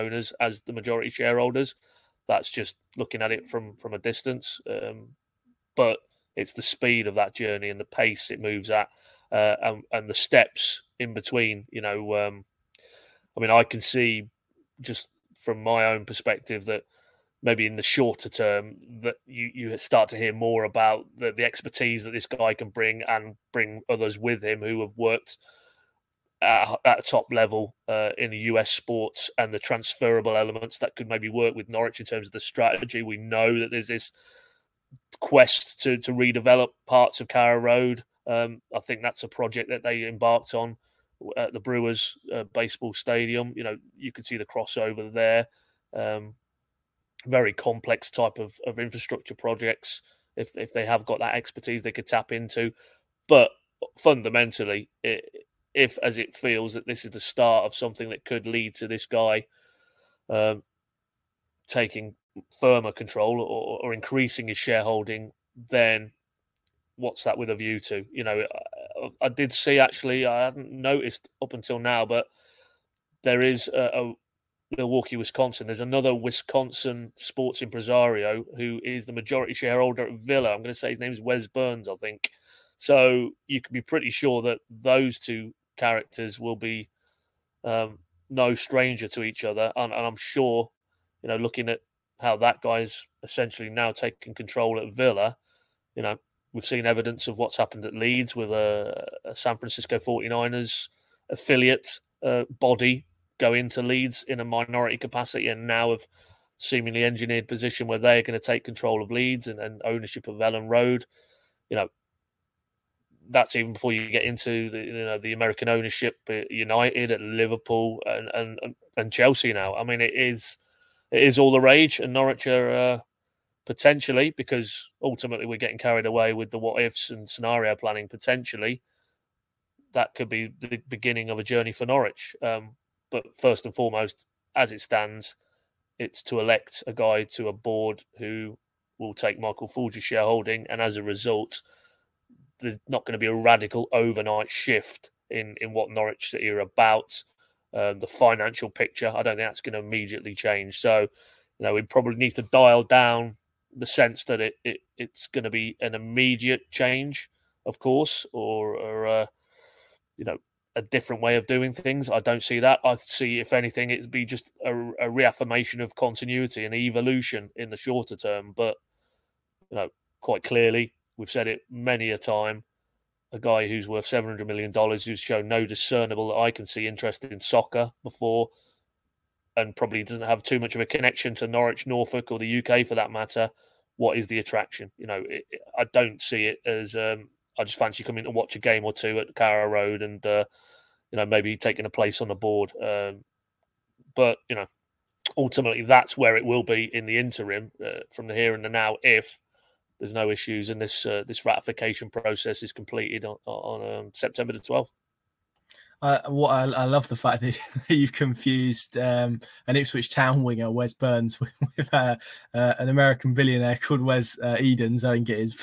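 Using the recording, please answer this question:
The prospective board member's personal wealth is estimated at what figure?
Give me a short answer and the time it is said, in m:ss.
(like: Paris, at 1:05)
$700 million, at 2:54.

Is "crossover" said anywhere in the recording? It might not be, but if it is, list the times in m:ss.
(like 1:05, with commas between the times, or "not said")
0:44.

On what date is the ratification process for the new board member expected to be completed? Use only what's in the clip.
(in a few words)
September 12.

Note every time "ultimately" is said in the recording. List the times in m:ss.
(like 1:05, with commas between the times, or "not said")
2:05, 3:15.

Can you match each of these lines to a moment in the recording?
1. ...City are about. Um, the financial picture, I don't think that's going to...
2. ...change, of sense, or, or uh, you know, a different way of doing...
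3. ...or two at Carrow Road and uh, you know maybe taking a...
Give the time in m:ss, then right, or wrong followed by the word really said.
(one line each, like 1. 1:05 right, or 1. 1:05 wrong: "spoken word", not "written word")
1. 2:26 right
2. 2:36 wrong: "course", not "sense"
3. 3:08 right.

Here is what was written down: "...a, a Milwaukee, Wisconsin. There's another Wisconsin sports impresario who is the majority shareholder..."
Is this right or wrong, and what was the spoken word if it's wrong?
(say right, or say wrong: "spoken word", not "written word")
right.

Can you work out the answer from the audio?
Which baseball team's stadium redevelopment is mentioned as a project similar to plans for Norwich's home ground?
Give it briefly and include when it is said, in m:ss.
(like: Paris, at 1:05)
Brewers, at 0:41.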